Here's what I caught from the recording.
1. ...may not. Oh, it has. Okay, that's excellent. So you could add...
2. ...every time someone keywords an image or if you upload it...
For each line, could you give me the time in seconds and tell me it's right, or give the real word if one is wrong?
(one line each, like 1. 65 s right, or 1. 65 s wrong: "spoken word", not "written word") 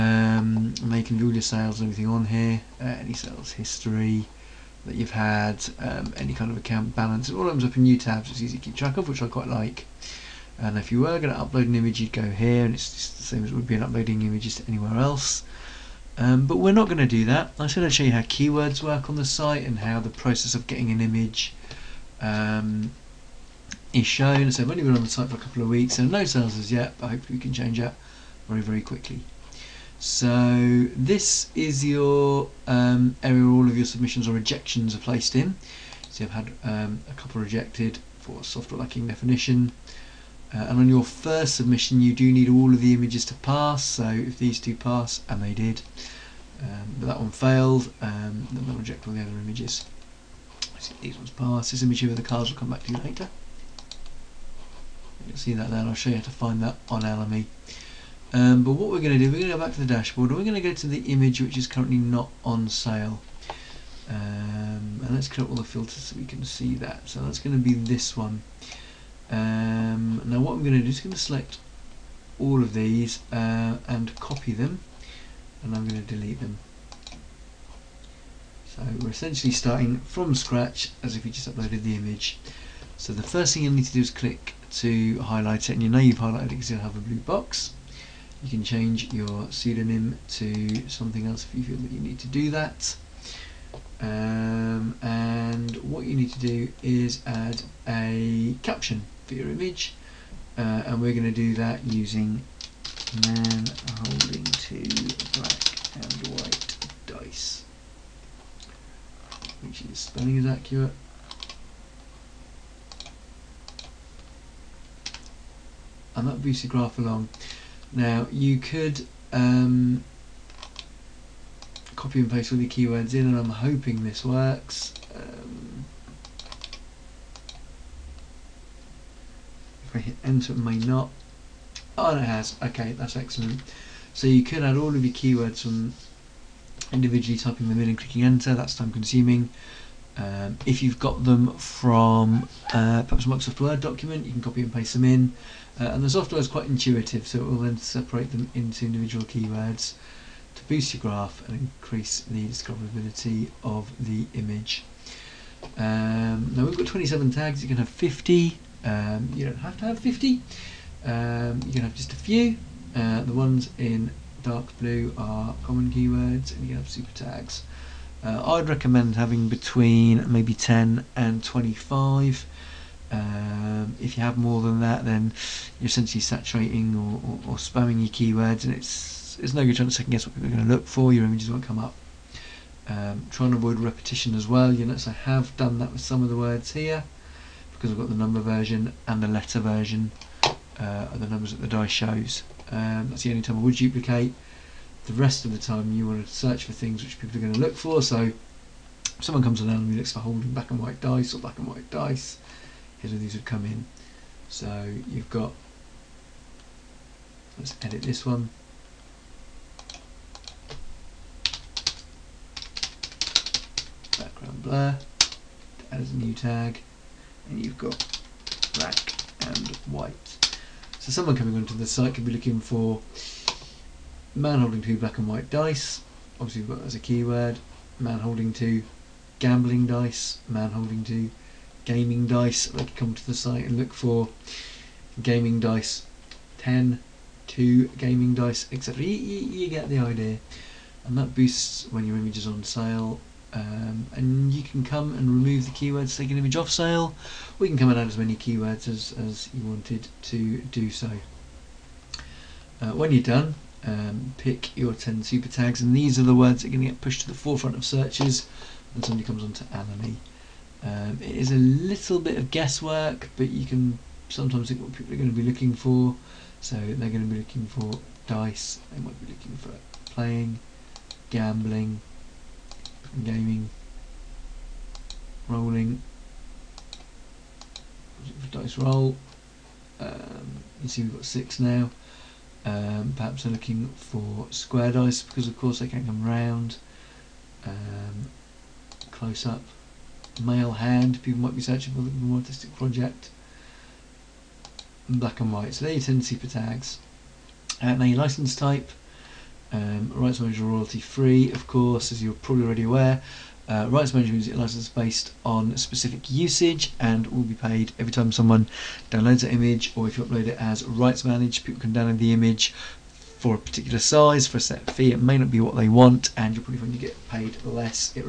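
1. 130 s right
2. 307 s wrong: "downloads", not "keywords".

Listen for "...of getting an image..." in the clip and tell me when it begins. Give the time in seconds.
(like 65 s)
20 s.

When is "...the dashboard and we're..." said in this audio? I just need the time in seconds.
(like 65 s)
59 s.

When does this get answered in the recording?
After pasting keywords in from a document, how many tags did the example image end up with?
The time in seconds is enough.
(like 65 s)
156 s.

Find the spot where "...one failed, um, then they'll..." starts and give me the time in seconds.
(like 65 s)
47 s.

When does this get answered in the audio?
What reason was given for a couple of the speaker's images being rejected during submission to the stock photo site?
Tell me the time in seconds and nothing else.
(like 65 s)
38 s.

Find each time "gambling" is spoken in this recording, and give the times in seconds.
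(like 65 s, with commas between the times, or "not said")
229 s, 271 s.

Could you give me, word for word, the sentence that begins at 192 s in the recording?
Um, that's the only time I would duplicate.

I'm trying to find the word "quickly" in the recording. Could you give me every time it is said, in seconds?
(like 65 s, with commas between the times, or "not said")
28 s.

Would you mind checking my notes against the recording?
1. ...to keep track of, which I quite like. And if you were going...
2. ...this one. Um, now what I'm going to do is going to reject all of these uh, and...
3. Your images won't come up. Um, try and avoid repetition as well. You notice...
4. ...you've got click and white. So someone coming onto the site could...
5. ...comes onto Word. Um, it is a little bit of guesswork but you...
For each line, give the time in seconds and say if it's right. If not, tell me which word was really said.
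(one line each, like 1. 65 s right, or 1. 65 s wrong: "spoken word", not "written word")
1. 8 s right
2. 67 s wrong: "select", not "reject"
3. 181 s right
4. 217 s wrong: "black", not "click"
5. 259 s wrong: "Alamy", not "Word".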